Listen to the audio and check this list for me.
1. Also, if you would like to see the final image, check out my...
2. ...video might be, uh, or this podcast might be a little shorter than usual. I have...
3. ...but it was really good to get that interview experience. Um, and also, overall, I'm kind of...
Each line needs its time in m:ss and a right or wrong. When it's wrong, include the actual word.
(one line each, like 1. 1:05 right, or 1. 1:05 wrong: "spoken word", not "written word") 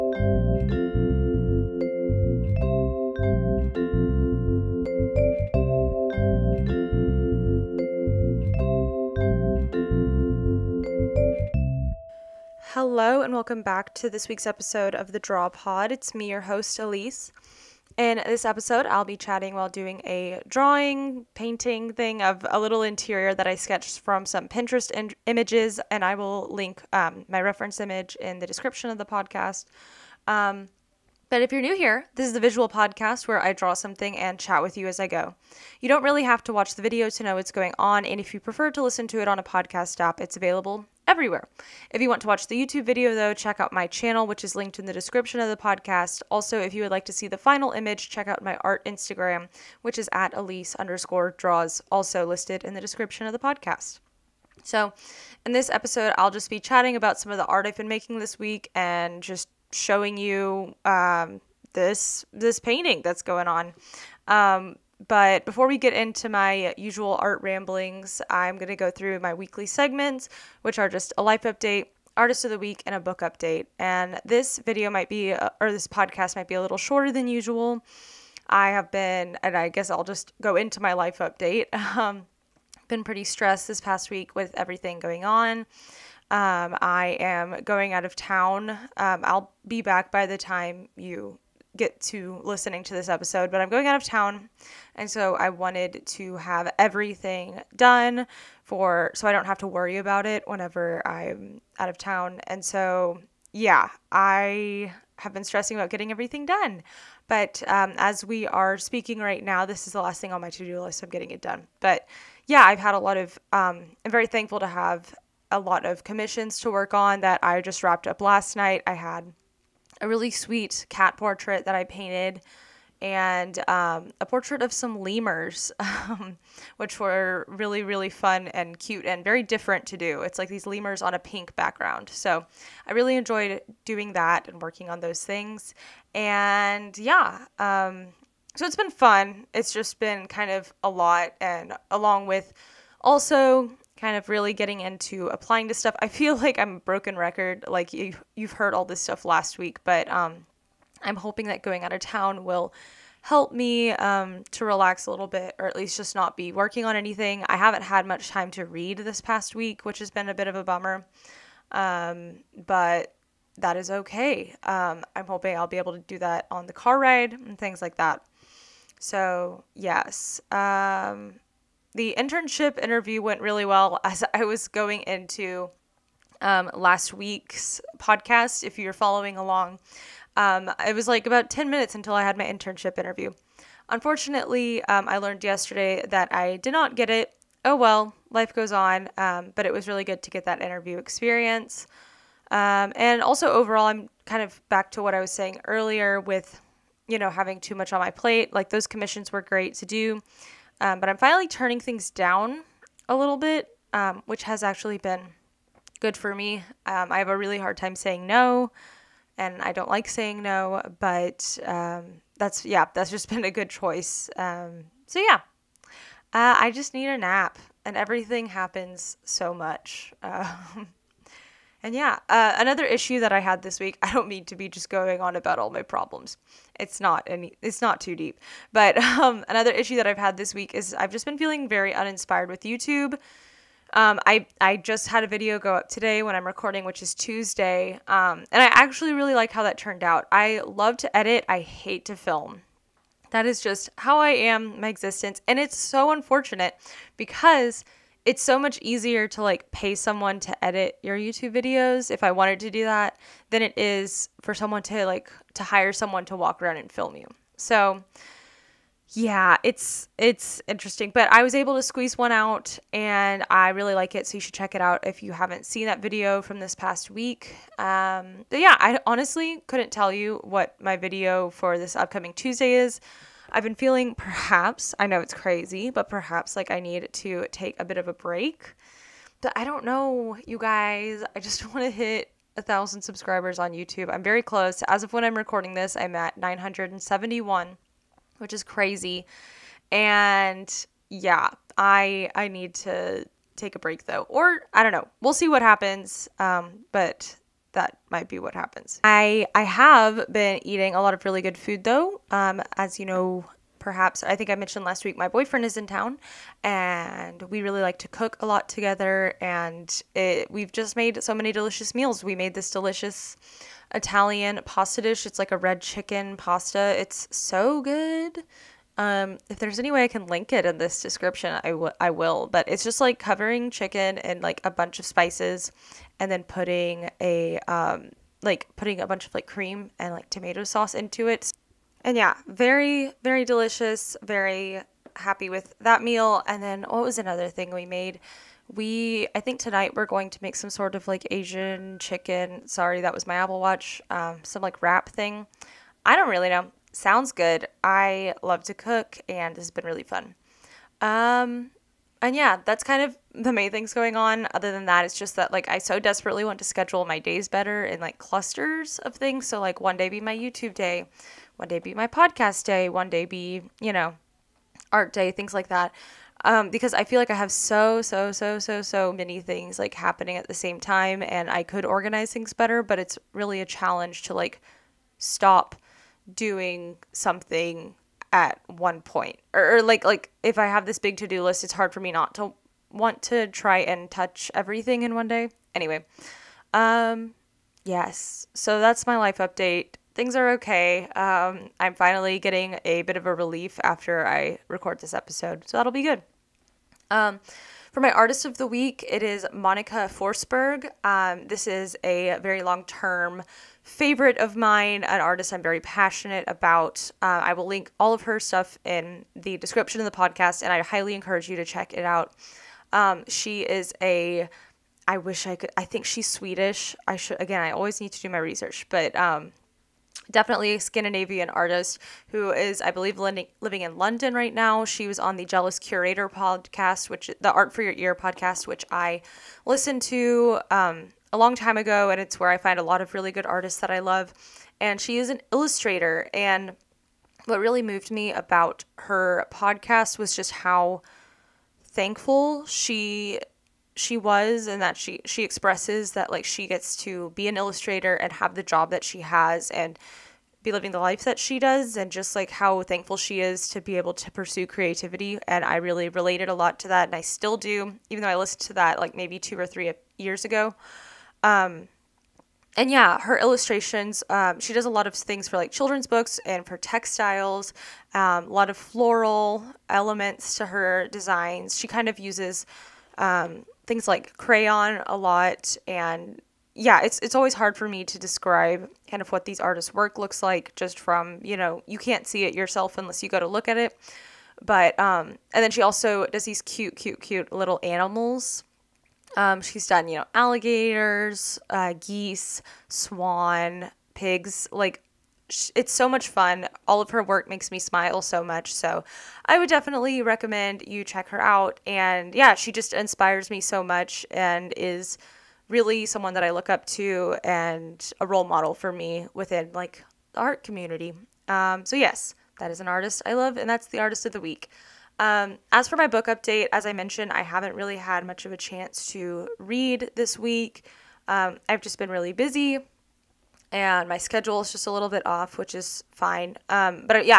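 1. 0:46 right
2. 1:14 right
3. 3:09 right.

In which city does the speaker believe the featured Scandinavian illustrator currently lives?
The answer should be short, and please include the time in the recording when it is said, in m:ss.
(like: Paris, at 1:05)
London, at 7:03.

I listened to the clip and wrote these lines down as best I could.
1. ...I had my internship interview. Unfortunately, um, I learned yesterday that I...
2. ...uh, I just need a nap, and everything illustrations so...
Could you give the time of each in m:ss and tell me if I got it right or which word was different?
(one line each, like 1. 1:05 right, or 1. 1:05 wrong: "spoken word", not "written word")
1. 3:02 right
2. 3:36 wrong: "happens", not "illustrations".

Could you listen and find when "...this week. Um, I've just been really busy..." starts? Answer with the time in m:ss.
8:40.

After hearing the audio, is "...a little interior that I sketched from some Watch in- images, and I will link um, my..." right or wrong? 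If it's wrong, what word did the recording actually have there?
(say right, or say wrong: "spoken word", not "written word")
wrong: "Pinterest", not "Watch".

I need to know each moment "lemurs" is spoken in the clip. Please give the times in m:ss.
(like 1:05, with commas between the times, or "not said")
2:04, 2:10.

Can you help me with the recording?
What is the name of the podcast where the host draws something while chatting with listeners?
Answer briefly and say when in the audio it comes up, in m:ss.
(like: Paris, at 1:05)
The Draw Pod, at 0:15.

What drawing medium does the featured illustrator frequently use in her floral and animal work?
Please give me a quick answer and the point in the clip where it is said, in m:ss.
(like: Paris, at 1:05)
Crayon, at 7:54.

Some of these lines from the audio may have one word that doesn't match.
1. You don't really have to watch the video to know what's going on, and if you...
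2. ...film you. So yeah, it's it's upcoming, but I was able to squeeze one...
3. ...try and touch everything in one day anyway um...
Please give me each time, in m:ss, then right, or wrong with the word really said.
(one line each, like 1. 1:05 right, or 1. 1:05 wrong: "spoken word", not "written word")
1. 0:35 right
2. 4:16 wrong: "interesting", not "upcoming"
3. 6:23 right.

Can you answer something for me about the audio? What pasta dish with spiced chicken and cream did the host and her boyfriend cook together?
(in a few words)
Red chicken pasta.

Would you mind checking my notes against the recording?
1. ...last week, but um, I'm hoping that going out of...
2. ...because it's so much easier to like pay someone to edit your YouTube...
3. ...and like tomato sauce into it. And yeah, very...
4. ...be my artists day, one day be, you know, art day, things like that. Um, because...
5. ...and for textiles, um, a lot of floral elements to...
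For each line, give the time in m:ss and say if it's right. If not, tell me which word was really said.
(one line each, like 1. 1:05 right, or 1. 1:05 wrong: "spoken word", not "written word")
1. 2:29 right
2. 4:07 right
3. 5:29 right
4. 6:01 wrong: "podcast", not "artists"
5. 7:46 right.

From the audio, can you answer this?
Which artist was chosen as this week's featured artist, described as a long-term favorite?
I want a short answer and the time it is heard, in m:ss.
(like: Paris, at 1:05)
Monika Forsberg, at 6:39.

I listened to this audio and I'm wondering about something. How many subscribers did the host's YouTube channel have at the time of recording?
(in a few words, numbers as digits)
971.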